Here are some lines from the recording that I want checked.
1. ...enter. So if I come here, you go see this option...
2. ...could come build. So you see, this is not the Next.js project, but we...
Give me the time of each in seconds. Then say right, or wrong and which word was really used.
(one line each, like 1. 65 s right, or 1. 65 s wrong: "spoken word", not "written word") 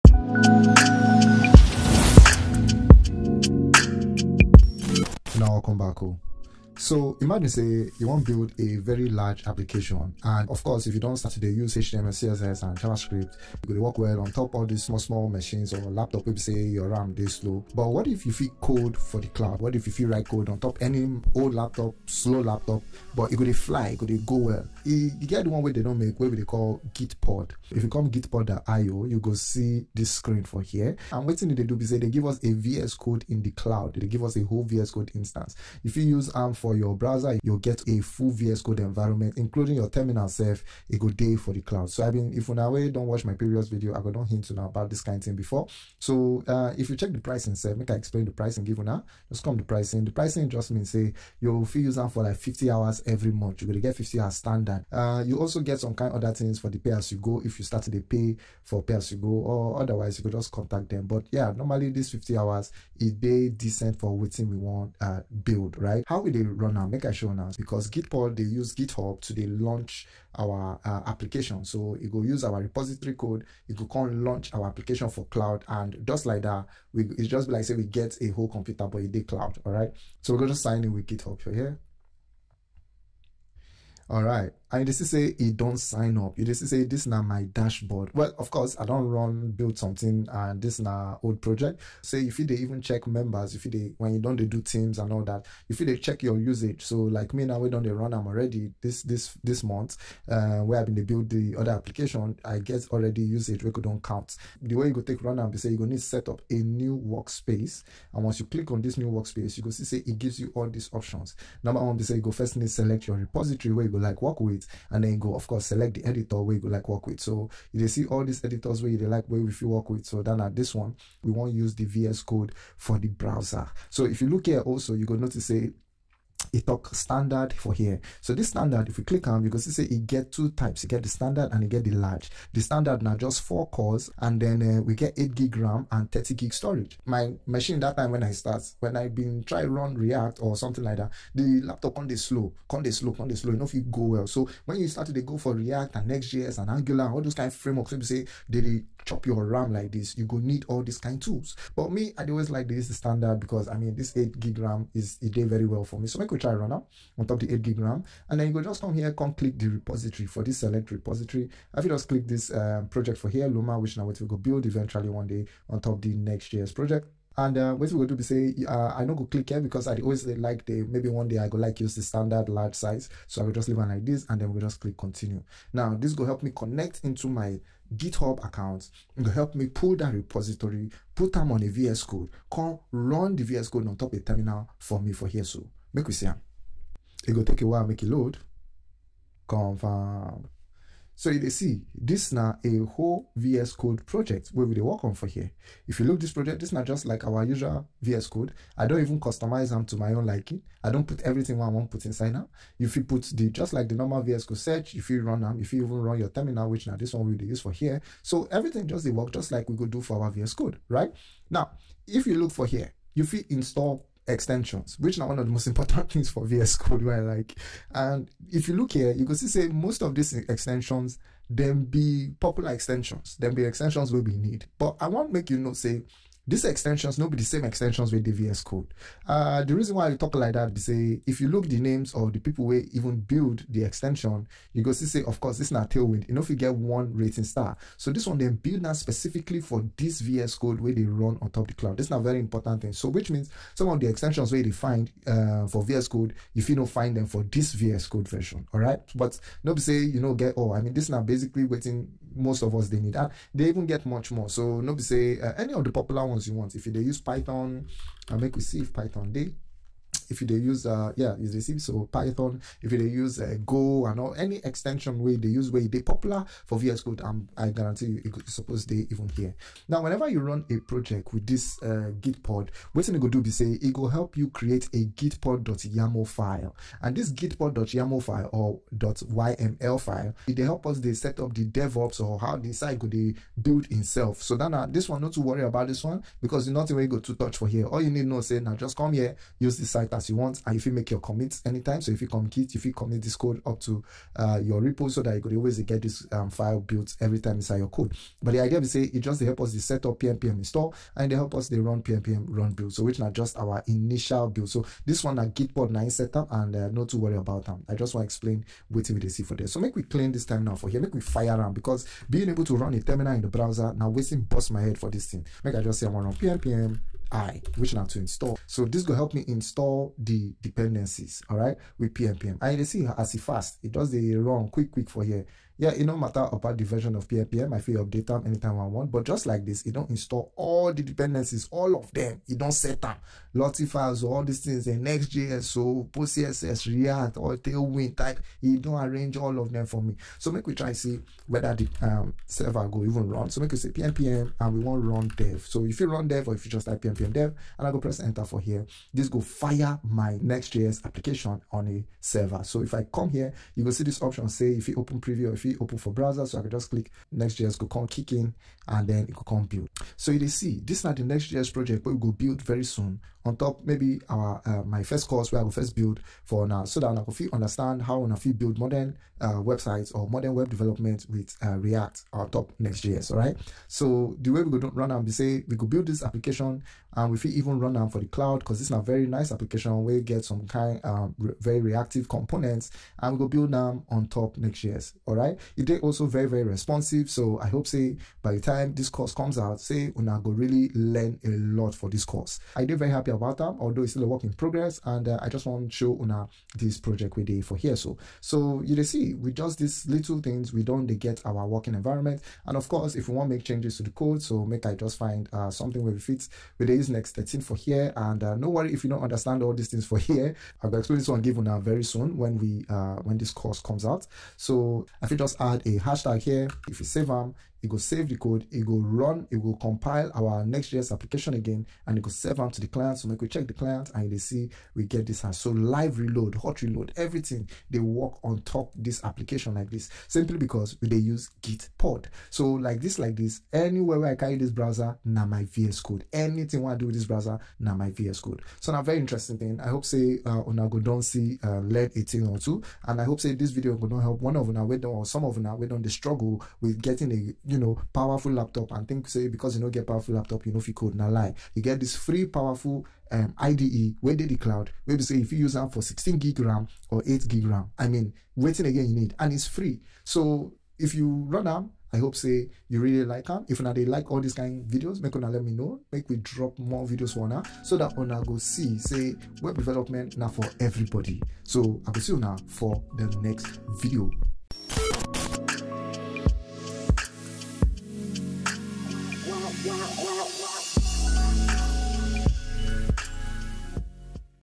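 1. 352 s wrong: "server", not "enter"
2. 359 s right.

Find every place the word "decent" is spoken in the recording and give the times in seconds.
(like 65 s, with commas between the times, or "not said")
63 s.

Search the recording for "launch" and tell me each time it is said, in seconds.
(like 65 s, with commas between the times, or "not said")
69 s, 74 s.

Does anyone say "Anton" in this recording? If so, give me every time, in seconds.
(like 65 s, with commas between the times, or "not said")
not said.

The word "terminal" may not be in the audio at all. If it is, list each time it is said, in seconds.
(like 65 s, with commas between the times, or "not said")
39 s, 184 s, 206 s, 313 s.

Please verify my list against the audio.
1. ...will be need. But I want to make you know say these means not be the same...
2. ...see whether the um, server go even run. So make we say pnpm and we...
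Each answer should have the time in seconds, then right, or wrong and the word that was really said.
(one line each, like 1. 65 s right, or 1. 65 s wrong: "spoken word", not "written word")
1. 224 s wrong: "extensions", not "means"
2. 340 s right.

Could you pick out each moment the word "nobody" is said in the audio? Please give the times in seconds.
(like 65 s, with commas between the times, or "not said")
249 s, 254 s.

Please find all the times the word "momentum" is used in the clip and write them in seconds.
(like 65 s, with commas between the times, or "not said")
not said.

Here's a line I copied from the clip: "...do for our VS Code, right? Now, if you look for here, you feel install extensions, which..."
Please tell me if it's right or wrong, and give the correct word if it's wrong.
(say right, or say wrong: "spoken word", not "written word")
right.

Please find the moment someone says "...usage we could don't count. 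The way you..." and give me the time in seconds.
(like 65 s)
103 s.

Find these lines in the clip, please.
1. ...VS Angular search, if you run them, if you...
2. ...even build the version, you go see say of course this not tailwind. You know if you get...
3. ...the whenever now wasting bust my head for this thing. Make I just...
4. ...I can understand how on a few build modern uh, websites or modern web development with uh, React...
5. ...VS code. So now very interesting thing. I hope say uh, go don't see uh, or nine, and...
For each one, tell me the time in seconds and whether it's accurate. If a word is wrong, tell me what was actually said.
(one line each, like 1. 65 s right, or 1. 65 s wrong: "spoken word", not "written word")
1. 204 s wrong: "Code", not "Angular"
2. 232 s wrong: "extension", not "version"
3. 313 s wrong: "browser", not "whenever"
4. 367 s right
5. 438 s wrong: "two", not "nine".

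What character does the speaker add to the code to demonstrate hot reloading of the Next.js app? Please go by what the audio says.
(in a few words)
hashtag.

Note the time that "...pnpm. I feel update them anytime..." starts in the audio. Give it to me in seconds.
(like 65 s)
327 s.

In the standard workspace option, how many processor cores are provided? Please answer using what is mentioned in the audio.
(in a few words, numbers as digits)
4.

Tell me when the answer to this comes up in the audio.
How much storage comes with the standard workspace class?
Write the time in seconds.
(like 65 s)
136 s.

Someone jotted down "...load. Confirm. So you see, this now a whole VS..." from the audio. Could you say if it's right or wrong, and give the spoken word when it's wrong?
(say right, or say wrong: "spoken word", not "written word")
right.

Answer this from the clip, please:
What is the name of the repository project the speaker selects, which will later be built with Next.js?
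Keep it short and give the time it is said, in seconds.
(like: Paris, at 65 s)
Luma, at 163 s.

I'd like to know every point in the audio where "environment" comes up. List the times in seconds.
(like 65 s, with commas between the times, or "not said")
38 s, 401 s.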